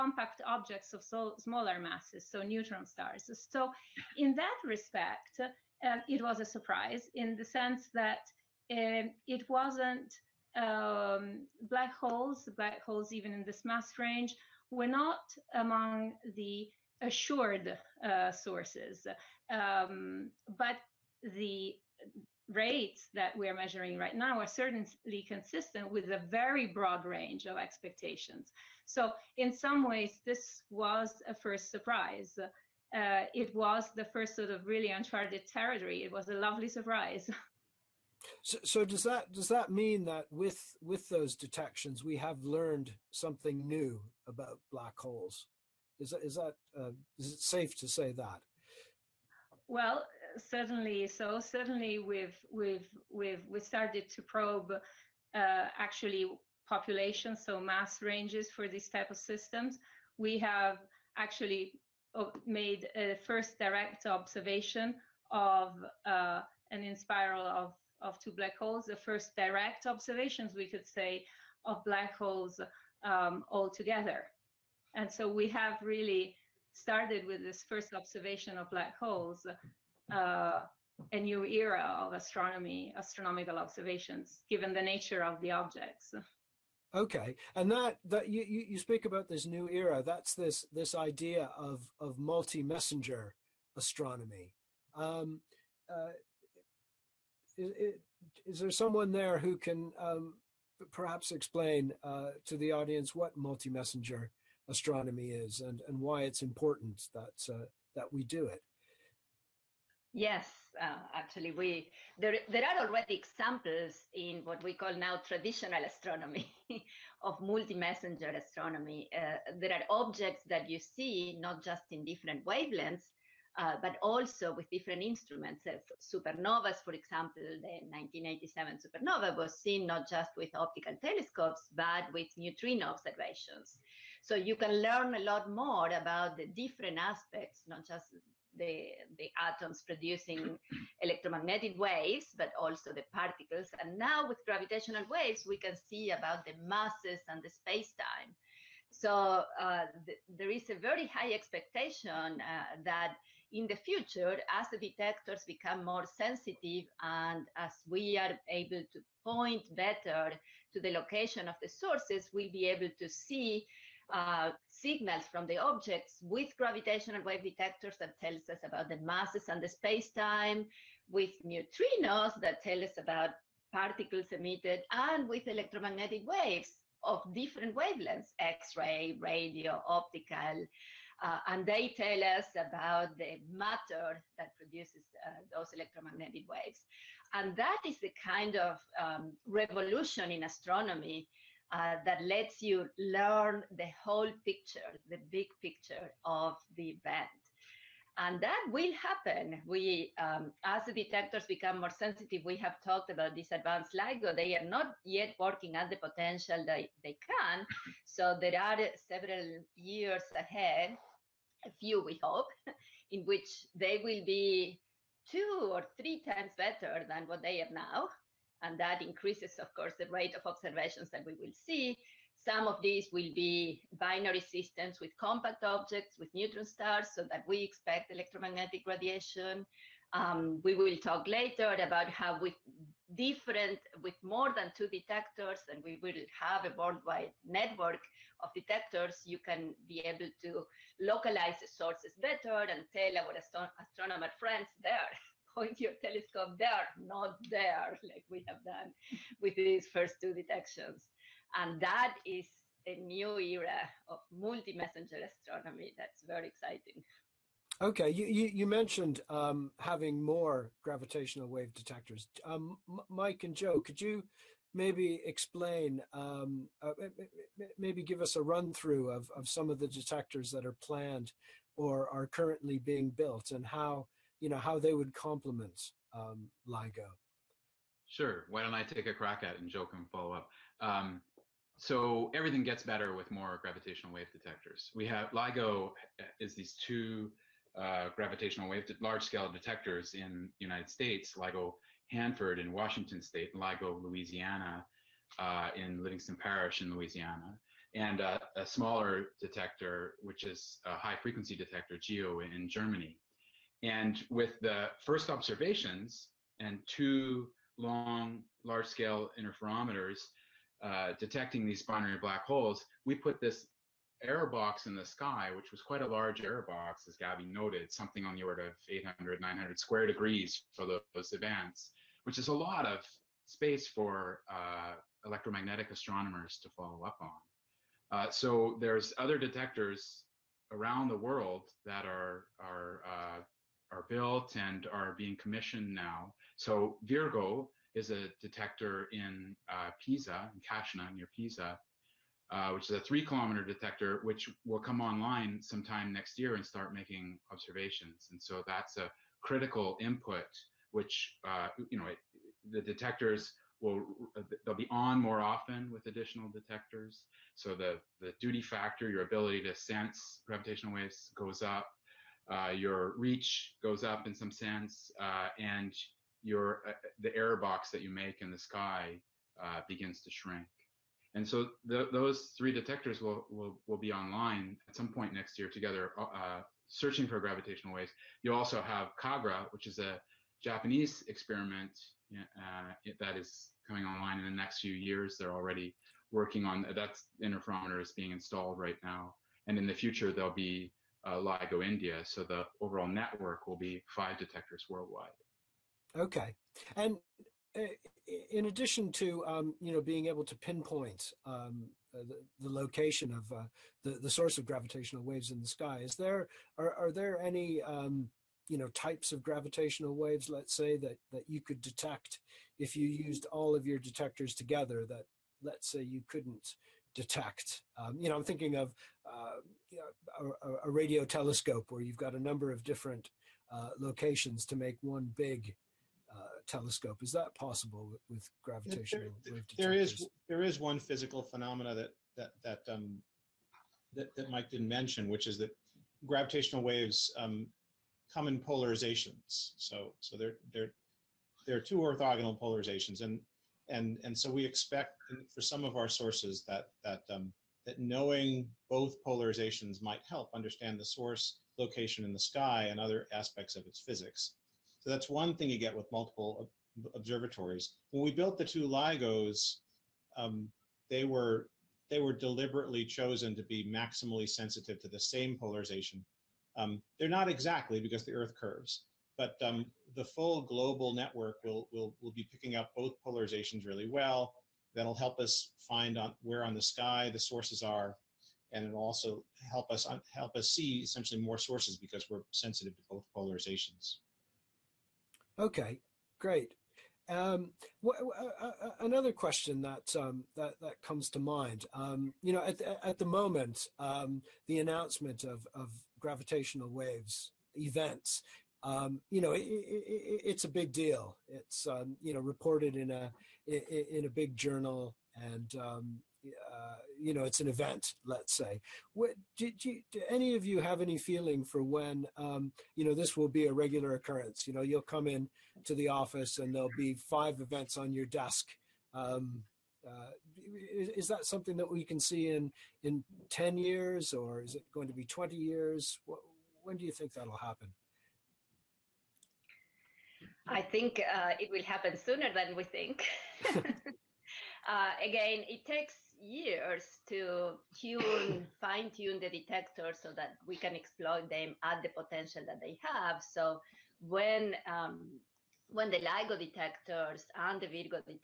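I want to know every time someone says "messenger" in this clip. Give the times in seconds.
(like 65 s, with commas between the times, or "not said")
92 s, 103 s, 117 s, 254 s.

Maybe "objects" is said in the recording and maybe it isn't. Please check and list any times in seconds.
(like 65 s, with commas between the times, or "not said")
0 s, 85 s, 120 s, 165 s, 225 s.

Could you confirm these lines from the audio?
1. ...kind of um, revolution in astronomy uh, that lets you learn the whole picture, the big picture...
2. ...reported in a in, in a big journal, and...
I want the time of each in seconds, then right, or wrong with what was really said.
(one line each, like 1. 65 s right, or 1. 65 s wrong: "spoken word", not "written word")
1. 188 s right
2. 502 s right.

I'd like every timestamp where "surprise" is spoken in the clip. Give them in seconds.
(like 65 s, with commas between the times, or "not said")
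6 s, 31 s, 36 s.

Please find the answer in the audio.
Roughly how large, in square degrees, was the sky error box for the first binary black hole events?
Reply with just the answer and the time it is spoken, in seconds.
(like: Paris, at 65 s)
800 to 900 square degrees, at 318 s.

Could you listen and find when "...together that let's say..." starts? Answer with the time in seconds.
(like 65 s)
414 s.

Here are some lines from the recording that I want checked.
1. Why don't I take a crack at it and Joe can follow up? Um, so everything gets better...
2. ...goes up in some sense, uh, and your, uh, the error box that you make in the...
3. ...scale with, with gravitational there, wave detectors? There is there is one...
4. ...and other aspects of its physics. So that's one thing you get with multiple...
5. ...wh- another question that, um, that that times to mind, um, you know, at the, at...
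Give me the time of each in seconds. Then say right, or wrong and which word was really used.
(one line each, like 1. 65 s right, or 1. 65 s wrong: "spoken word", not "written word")
1. 278 s right
2. 363 s right
3. 427 s wrong: "possible", not "scale"
4. 452 s right
5. 488 s wrong: "comes", not "times".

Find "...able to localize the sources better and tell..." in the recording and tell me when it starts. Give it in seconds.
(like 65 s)
239 s.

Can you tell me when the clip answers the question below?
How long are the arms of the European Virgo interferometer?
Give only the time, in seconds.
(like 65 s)
342 s.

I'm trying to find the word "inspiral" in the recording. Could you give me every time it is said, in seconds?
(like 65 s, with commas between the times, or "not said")
66 s.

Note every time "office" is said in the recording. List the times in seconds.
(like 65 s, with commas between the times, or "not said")
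516 s.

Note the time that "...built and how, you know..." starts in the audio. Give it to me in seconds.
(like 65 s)
273 s.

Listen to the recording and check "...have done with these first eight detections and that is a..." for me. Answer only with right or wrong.
wrong.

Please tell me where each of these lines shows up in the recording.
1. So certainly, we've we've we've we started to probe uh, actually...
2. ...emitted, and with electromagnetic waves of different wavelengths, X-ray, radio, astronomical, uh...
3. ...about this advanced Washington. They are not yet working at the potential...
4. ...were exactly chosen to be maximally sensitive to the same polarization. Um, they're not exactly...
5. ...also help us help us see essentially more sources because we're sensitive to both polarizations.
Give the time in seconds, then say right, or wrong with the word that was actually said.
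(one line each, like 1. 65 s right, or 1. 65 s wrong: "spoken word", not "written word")
1. 51 s right
2. 174 s wrong: "optical", not "astronomical"
3. 203 s wrong: "LIGO", not "Washington"
4. 462 s wrong: "deliberately", not "exactly"
5. 479 s right.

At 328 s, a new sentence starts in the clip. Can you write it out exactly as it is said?
Uh, so there's other detectors around the world that are are uh, are built and are being commissioned now.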